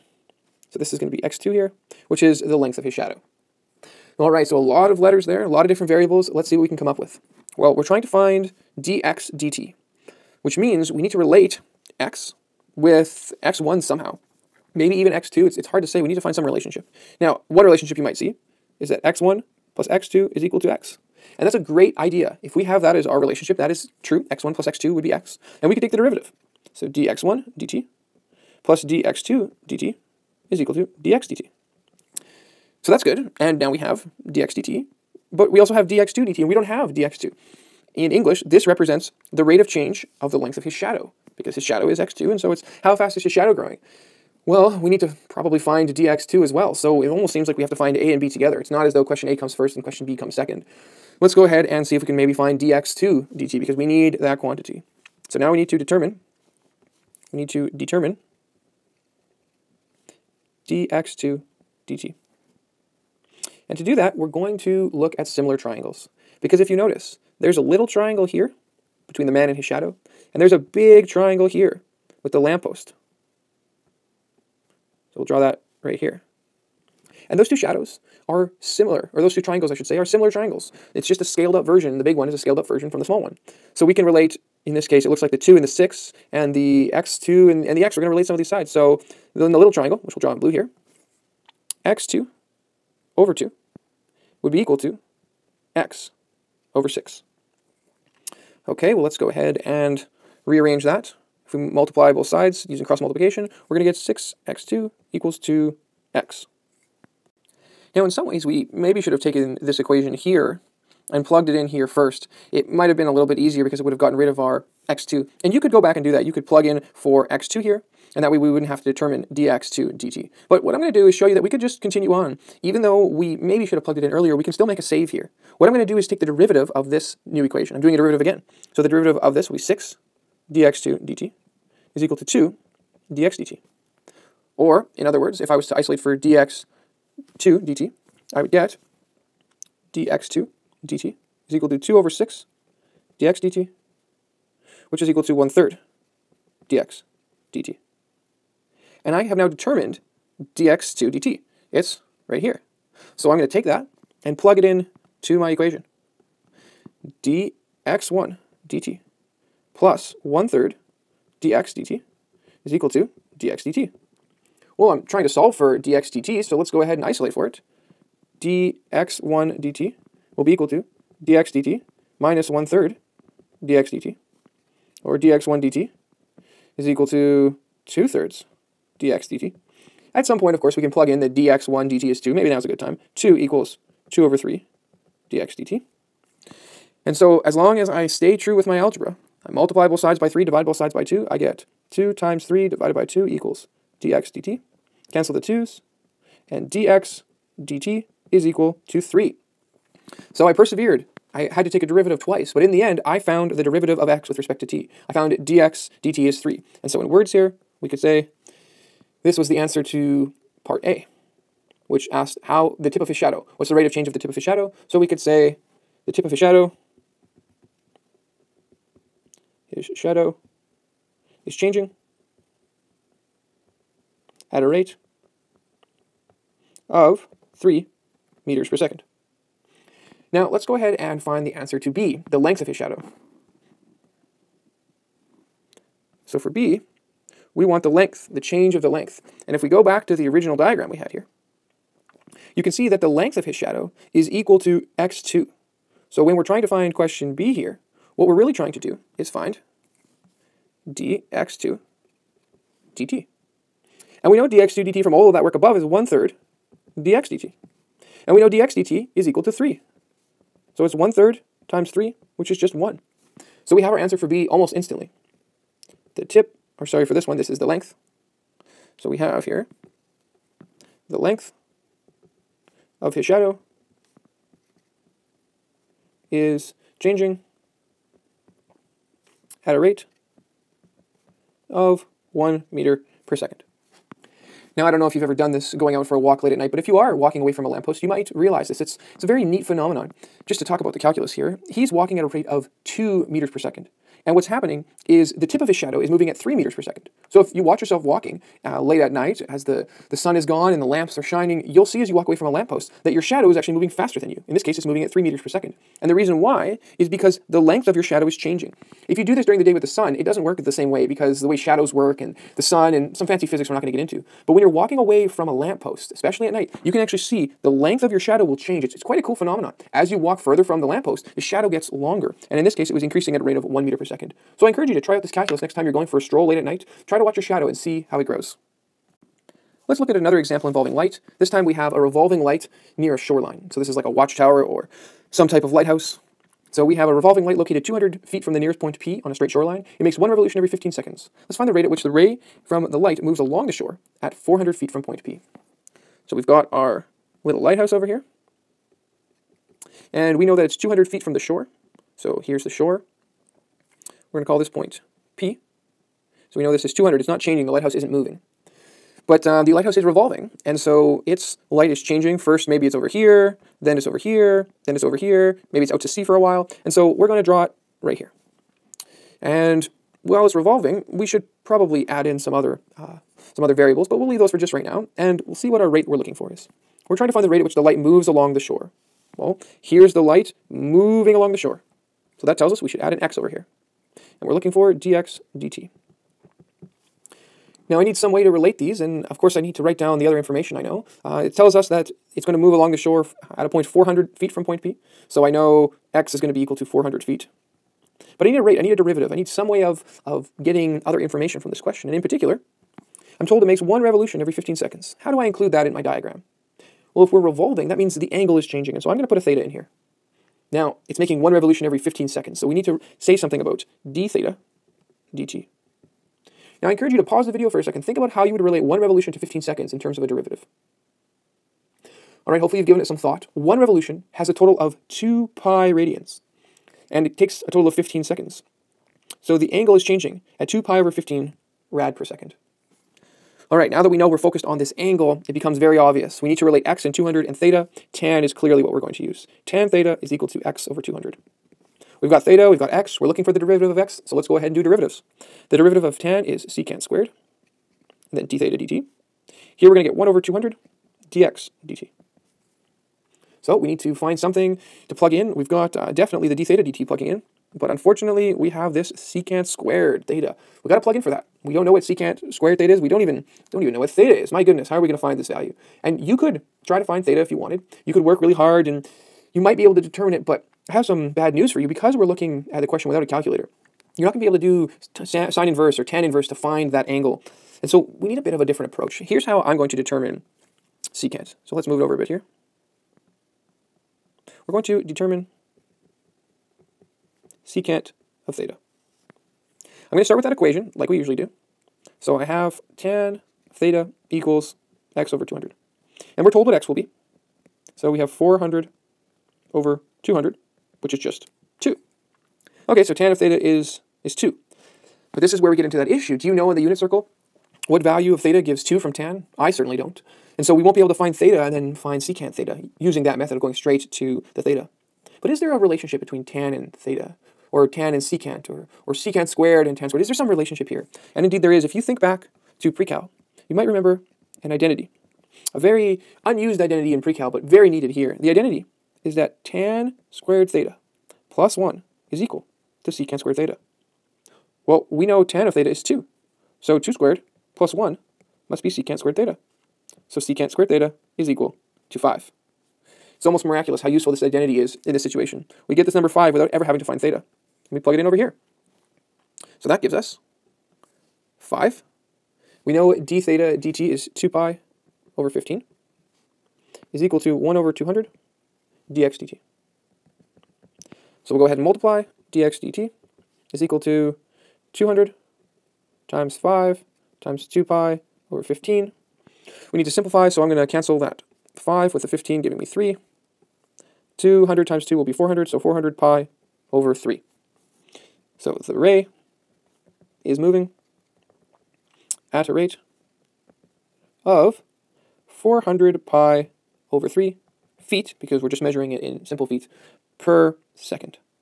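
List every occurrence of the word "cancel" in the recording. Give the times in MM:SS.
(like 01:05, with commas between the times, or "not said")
03:15, 09:30.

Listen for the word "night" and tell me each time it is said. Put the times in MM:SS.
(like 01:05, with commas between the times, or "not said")
04:46, 04:59, 05:16, 05:26.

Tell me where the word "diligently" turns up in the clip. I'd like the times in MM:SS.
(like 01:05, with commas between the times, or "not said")
not said.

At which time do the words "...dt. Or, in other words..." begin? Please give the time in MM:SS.
02:13.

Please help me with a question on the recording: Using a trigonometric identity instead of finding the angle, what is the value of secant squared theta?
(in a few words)
5.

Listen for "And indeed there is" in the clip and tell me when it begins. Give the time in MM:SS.
08:41.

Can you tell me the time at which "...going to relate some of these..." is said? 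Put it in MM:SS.
01:28.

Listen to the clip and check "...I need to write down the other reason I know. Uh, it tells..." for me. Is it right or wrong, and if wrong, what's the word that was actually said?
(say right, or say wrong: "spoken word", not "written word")
wrong: "information", not "reason".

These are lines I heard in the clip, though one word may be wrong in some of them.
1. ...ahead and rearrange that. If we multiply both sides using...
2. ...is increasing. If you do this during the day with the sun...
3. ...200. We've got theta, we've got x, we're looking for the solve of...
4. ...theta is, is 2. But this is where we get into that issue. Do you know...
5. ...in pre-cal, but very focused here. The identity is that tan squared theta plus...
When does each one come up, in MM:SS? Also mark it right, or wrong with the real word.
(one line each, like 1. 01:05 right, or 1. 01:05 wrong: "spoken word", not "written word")
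1. 01:39 right
2. 05:08 wrong: "changing", not "increasing"
3. 07:21 wrong: "derivative", not "solve"
4. 08:23 right
5. 08:47 wrong: "needed", not "focused".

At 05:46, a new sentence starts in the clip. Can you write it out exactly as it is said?
So we've got our little lighthouse over here.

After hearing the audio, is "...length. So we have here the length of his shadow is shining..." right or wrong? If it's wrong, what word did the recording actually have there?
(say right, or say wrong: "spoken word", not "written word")
wrong: "changing", not "shining".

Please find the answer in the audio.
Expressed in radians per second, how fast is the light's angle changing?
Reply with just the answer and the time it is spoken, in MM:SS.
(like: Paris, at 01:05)
2 pi over 15, at 07:10.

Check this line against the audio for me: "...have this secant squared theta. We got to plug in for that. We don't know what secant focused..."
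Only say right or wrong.
wrong.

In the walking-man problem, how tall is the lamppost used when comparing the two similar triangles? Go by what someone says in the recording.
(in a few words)
6.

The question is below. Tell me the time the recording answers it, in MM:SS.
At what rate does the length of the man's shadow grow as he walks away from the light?
04:42.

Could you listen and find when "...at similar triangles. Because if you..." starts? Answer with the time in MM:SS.
01:05.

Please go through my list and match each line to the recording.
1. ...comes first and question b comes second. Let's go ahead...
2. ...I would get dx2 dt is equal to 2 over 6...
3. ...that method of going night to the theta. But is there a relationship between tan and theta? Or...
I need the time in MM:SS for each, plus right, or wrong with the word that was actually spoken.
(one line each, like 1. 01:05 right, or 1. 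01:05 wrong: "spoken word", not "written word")
1. 00:49 right
2. 02:18 right
3. 08:33 wrong: "straight", not "night".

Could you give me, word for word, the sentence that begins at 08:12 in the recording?
So I have tan theta equals x over 200.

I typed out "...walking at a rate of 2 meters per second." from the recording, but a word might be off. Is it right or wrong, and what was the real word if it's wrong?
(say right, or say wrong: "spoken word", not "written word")
right.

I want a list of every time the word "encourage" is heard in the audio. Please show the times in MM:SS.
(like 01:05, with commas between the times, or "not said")
05:24, 06:56.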